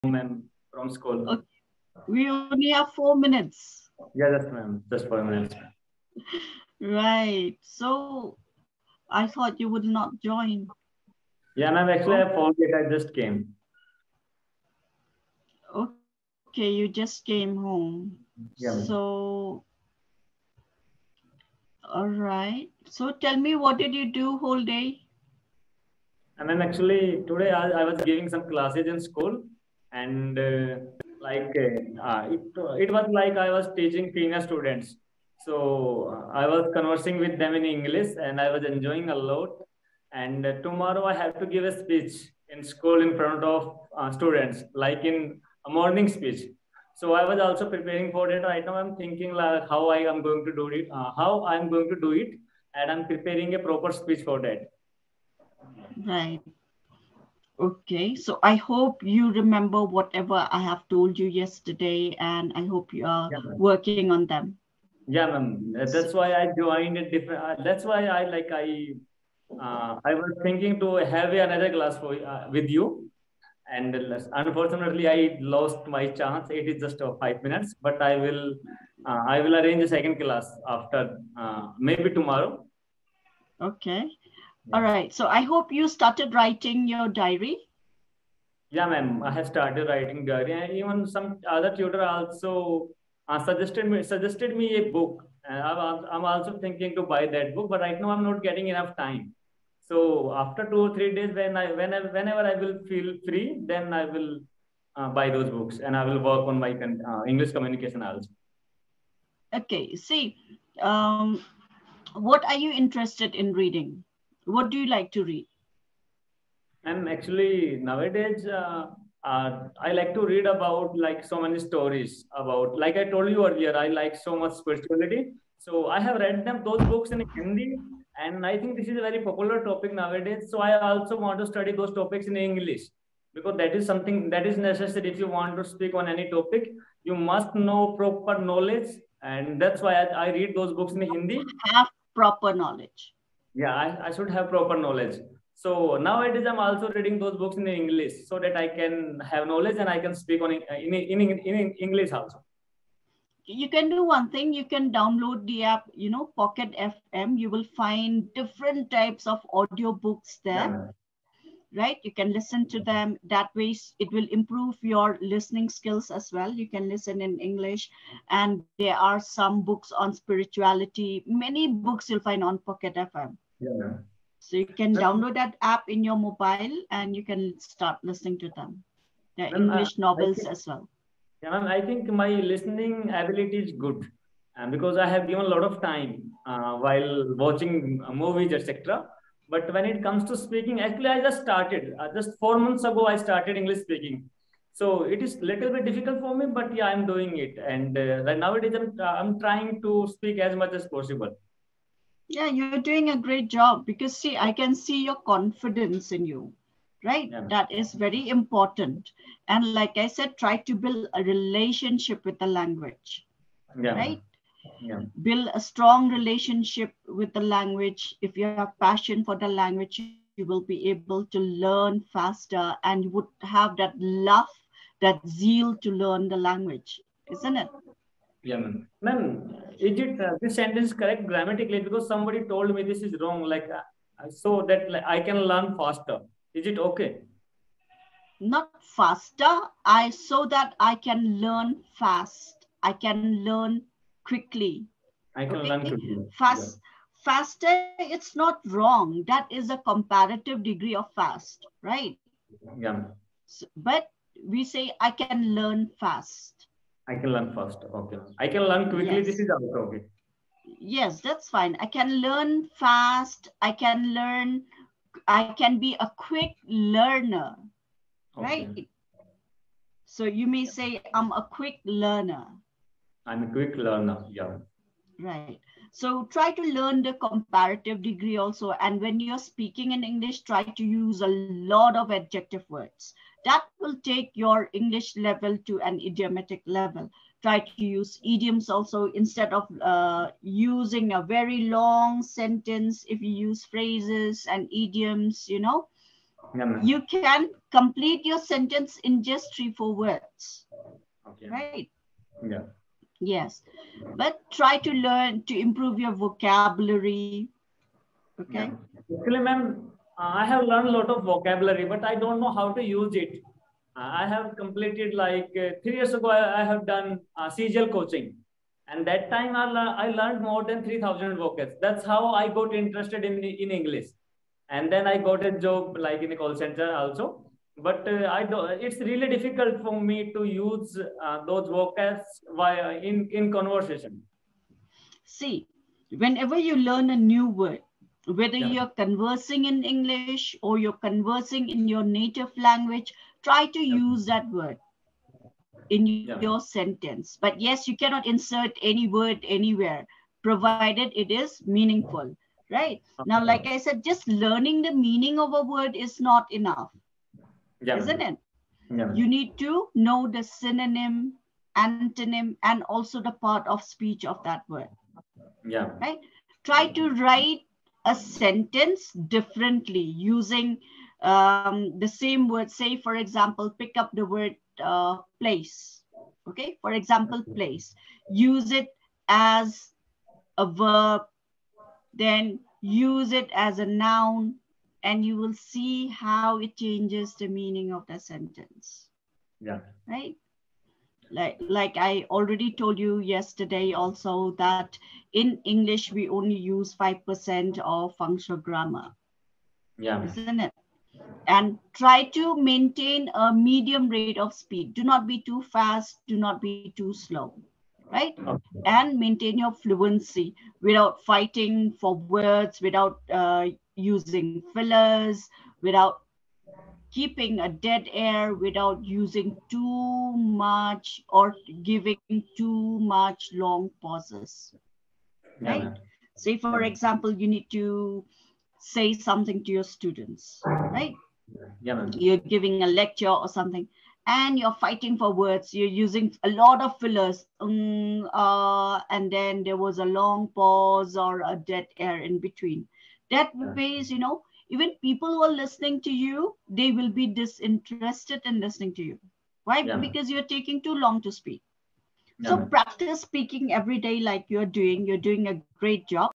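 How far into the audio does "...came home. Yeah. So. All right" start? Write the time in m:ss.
0:17.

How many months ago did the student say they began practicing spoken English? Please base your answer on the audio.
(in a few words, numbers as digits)
4.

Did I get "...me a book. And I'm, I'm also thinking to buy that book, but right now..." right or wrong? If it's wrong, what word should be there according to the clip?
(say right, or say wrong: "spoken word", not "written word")
right.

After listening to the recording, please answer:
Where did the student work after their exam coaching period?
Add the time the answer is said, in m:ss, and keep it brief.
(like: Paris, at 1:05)
a call center, at 5:26.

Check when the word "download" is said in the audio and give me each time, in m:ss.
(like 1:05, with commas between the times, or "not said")
2:34, 2:54.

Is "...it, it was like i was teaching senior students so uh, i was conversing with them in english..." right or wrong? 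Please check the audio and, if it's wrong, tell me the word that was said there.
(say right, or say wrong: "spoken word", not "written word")
right.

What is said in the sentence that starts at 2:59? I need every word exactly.
The English novels think, as well.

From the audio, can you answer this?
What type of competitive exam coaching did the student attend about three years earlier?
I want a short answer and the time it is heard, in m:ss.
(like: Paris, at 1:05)
CGL, at 5:17.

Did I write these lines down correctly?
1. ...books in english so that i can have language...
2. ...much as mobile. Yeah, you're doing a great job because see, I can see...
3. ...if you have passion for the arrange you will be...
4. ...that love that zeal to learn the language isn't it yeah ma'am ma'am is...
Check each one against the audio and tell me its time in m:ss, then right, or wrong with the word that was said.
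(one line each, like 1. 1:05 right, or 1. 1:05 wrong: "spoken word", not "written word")
1. 2:27 wrong: "knowledge", not "language"
2. 3:20 wrong: "possible", not "mobile"
3. 3:38 wrong: "language", not "arrange"
4. 3:43 right.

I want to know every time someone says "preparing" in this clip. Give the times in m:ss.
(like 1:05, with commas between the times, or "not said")
0:47, 0:53.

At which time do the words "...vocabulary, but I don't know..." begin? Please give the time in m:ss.
5:11.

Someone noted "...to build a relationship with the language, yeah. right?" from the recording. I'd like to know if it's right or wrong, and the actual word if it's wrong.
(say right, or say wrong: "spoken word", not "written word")
right.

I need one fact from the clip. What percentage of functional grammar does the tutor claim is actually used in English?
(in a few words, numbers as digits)
5%.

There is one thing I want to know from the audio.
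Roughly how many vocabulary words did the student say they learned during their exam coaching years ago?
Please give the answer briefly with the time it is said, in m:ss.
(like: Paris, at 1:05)
3000, at 5:20.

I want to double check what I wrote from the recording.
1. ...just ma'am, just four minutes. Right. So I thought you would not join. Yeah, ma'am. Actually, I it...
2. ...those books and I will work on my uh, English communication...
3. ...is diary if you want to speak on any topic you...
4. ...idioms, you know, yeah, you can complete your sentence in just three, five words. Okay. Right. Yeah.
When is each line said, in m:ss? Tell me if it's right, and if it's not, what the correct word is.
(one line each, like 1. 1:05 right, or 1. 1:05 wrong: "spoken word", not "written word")
1. 0:04 right
2. 1:45 right
3. 2:14 wrong: "necessary", not "diary"
4. 4:54 wrong: "four", not "five".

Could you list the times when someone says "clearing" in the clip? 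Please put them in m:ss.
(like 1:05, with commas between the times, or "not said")
not said.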